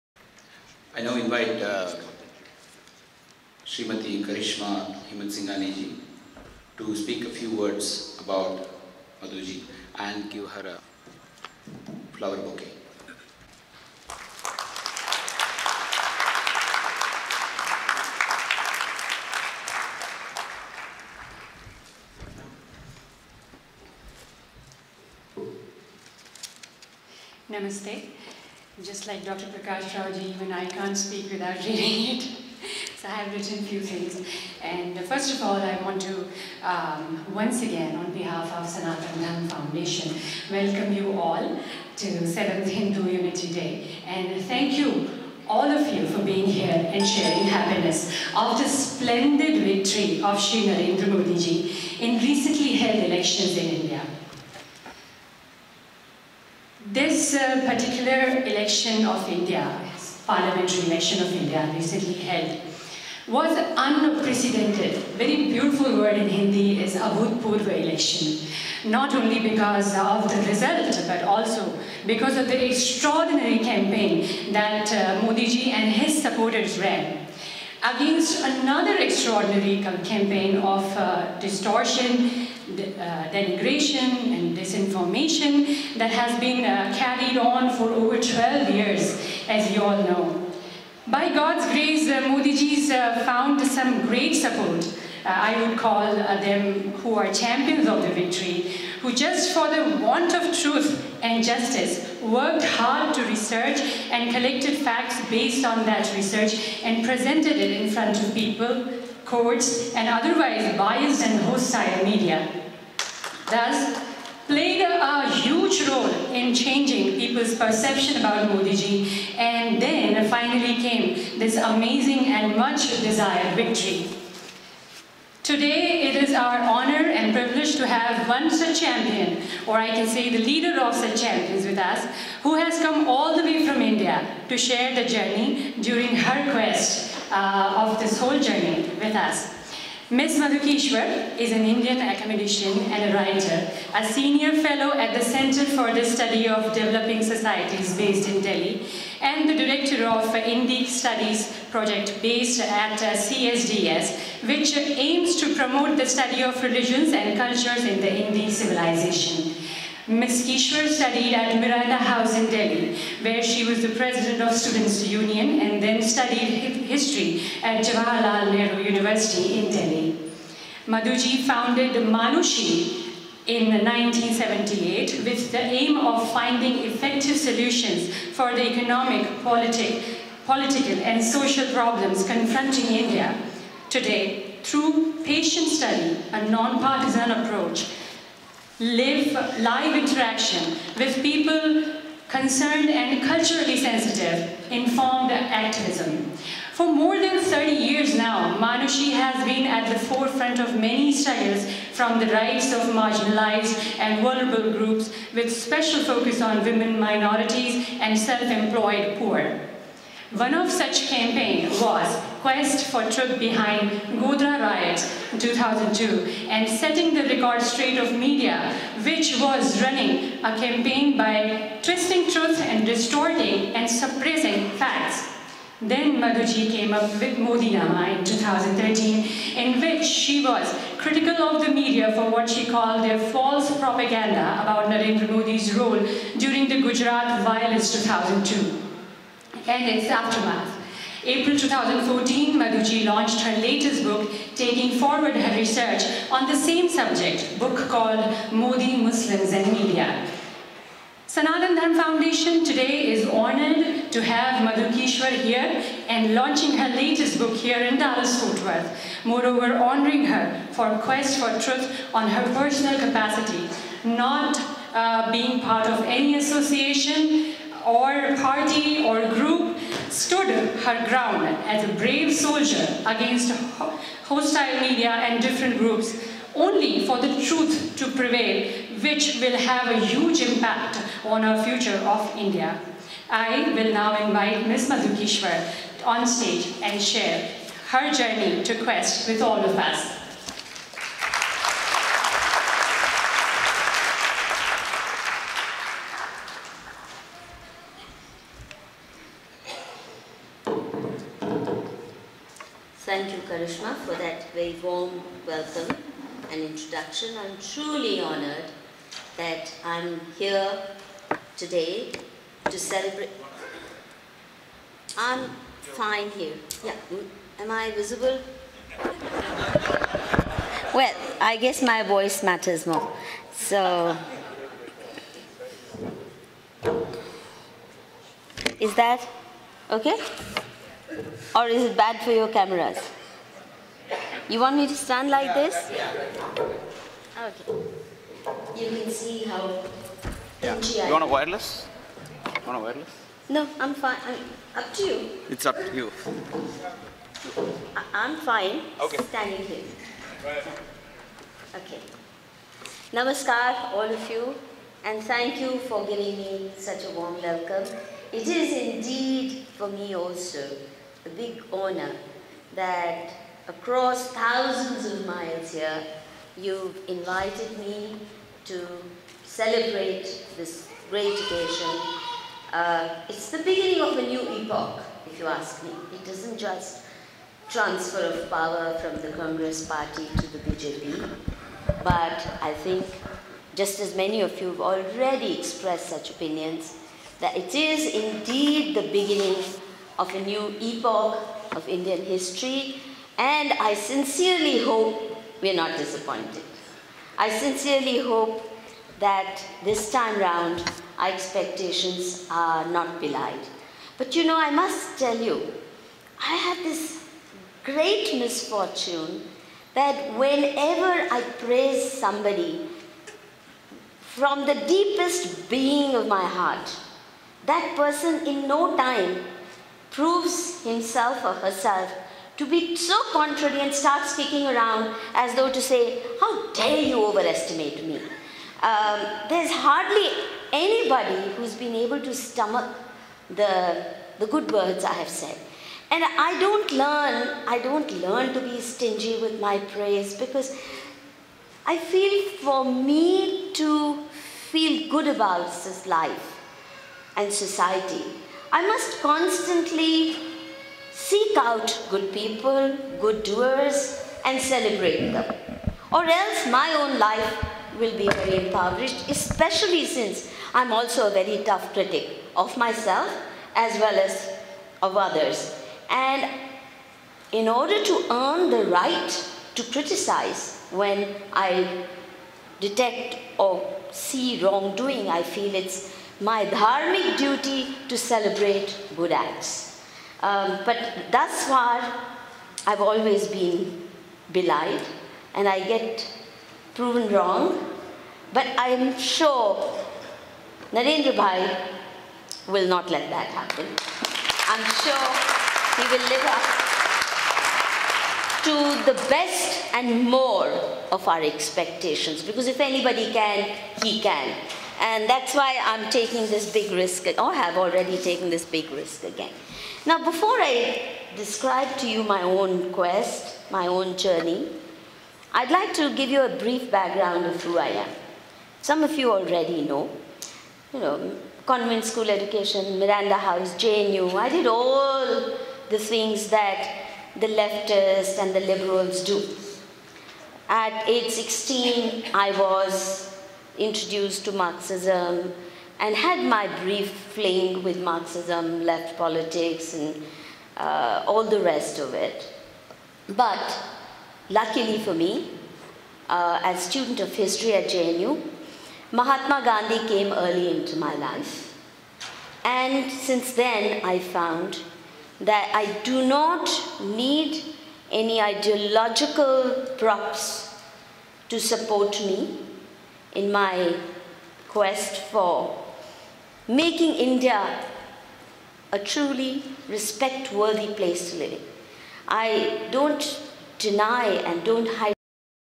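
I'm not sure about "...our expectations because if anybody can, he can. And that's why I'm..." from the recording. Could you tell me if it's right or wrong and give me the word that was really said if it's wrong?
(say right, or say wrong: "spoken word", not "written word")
right.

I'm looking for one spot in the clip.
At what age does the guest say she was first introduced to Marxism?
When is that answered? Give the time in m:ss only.
8:51.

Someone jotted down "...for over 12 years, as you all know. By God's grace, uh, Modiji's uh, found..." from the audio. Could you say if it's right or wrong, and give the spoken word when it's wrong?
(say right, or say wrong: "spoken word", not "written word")
right.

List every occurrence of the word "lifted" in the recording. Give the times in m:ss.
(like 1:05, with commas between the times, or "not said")
not said.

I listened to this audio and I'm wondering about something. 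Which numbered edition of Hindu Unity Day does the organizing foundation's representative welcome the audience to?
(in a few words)
7th.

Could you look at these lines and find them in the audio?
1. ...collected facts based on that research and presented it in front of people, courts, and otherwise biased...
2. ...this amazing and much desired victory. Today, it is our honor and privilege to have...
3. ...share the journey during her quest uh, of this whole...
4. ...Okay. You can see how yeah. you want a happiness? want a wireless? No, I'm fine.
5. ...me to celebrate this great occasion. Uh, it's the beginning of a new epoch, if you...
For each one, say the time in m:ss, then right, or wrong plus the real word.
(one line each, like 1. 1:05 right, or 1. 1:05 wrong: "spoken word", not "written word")
1. 1:44 right
2. 2:01 right
3. 2:14 right
4. 5:37 wrong: "wireless", not "happiness"
5. 6:07 right.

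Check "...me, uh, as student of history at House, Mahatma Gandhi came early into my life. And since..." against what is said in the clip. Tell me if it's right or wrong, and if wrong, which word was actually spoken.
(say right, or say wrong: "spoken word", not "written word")
wrong: "JNU", not "House".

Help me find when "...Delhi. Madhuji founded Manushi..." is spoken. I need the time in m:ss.
2:49.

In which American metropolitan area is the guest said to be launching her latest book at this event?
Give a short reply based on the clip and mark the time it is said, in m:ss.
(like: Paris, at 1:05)
Dallas Fort Worth, at 4:17.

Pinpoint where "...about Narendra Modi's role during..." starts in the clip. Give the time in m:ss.
3:54.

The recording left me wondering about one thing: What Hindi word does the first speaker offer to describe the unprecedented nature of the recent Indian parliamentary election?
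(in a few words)
abhutpurva.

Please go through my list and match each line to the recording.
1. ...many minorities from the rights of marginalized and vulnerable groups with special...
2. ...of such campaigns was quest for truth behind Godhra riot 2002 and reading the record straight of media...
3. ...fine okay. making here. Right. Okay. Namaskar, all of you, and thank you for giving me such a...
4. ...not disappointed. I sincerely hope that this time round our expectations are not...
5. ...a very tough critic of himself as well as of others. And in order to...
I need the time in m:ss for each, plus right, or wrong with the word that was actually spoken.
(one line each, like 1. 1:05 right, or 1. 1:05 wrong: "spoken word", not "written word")
1. 3:20 wrong: "struggles", not "minorities"
2. 3:30 wrong: "setting", not "reading"
3. 5:48 wrong: "standing", not "making"
4. 6:35 right
5. 7:41 wrong: "myself", not "himself".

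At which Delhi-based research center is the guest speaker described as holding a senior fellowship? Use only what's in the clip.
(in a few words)
Center for the Study of Developing Societies.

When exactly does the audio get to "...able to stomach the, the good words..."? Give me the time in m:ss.
7:11.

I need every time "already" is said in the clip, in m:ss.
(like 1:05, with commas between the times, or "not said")
6:24, 8:27, 8:39.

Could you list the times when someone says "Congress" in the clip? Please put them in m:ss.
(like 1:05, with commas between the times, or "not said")
6:19.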